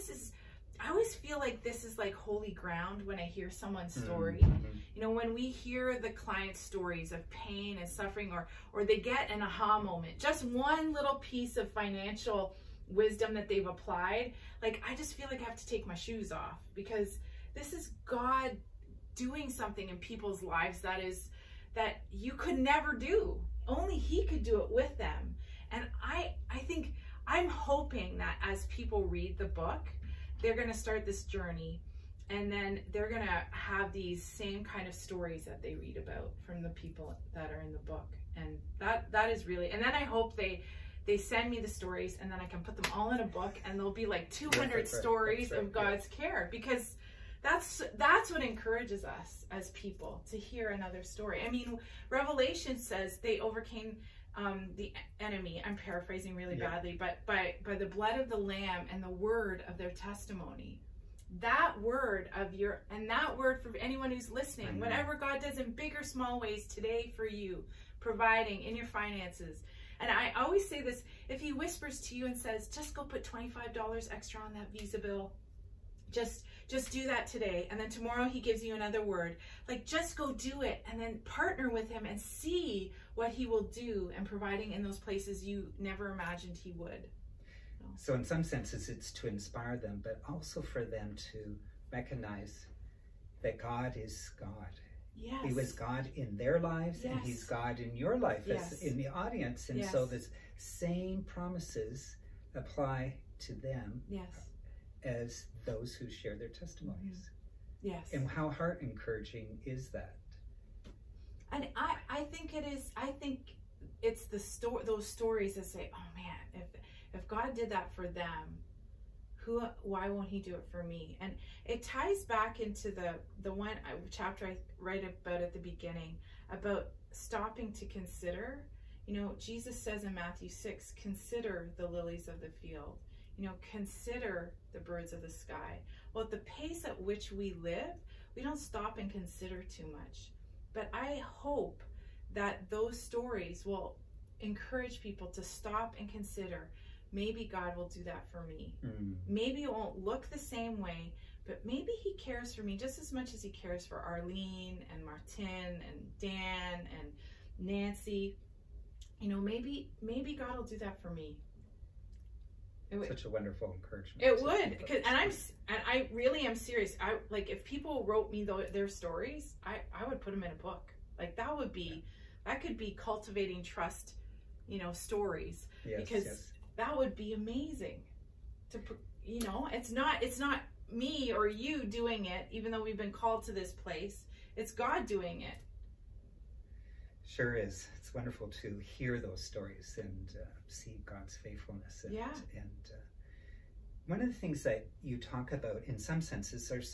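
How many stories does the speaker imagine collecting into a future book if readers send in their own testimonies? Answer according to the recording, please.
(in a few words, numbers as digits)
200.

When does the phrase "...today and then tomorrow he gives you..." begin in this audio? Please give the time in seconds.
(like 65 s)
77 s.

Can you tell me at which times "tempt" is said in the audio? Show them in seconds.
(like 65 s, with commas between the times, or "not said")
not said.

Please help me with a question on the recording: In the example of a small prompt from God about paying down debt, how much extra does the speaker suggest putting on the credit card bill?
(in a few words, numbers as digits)
$25.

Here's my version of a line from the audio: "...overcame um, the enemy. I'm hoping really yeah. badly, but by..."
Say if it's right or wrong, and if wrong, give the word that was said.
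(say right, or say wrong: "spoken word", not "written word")
wrong: "paraphrasing", not "hoping".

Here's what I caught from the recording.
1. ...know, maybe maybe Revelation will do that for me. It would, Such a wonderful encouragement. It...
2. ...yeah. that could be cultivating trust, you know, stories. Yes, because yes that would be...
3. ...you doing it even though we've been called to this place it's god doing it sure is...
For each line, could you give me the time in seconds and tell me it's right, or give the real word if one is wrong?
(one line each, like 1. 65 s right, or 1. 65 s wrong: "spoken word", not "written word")
1. 159 s wrong: "God", not "Revelation"
2. 172 s right
3. 181 s right.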